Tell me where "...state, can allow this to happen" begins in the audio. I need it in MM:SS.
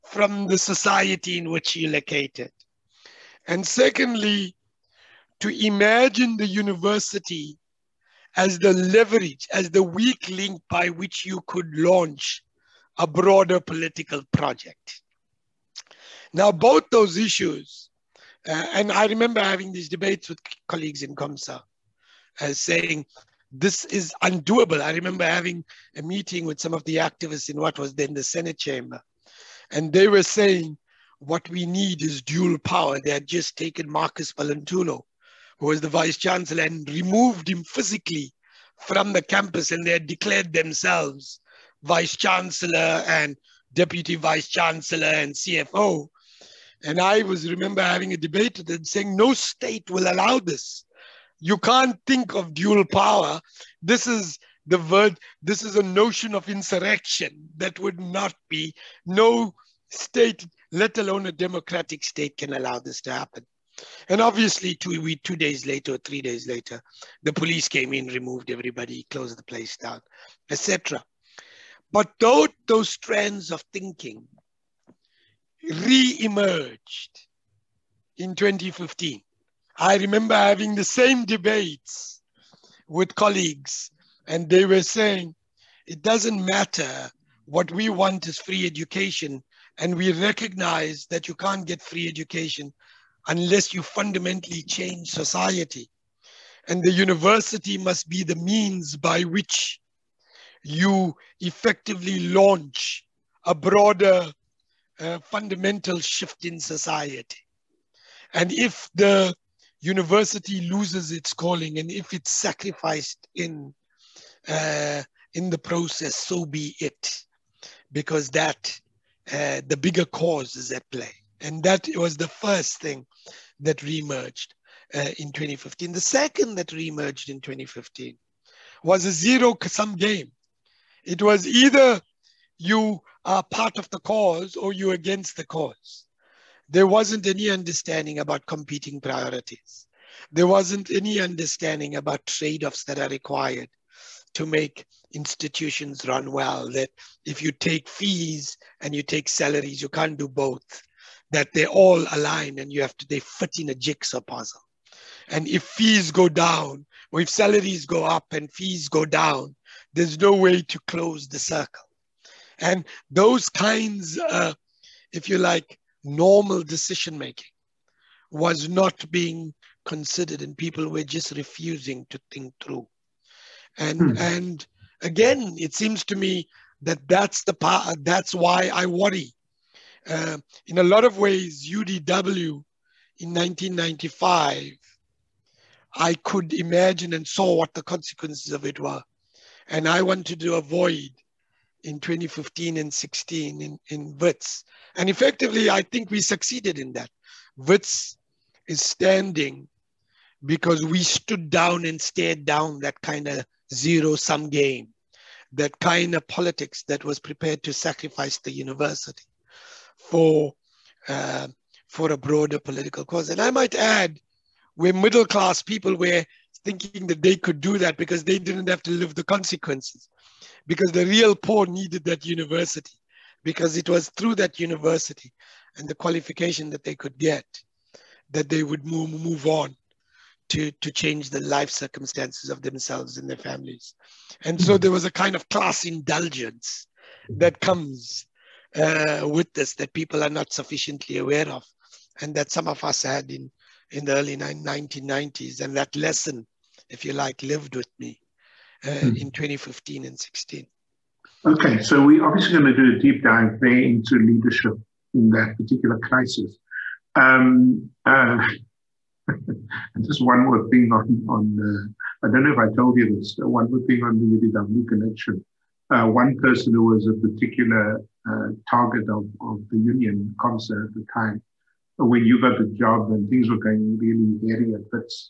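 01:02.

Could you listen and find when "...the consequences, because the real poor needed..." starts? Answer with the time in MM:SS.
03:39.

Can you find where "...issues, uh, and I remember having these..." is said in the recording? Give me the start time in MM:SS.
00:17.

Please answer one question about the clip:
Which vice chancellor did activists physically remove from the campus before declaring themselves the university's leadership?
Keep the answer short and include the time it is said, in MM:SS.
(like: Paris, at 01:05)
Marcus Valentulo, at 00:33.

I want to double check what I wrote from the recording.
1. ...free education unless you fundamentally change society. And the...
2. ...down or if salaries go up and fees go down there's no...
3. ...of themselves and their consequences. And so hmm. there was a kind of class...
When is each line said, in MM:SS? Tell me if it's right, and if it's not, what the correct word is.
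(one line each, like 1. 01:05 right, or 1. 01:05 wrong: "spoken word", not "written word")
1. 01:31 right
2. 02:36 right
3. 03:52 wrong: "families", not "consequences".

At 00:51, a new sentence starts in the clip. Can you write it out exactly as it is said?
You can't think of dual power.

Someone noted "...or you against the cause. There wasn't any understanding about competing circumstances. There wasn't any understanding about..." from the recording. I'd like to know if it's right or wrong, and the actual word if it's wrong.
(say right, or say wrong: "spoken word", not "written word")
wrong: "priorities", not "circumstances".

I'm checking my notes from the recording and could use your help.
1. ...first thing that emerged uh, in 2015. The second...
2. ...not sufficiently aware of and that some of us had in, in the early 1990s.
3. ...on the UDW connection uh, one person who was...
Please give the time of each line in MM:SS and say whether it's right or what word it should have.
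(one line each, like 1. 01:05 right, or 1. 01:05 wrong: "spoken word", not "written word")
1. 02:02 right
2. 04:00 right
3. 04:24 right.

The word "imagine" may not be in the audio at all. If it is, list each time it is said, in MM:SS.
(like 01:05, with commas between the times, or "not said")
00:05, 03:06.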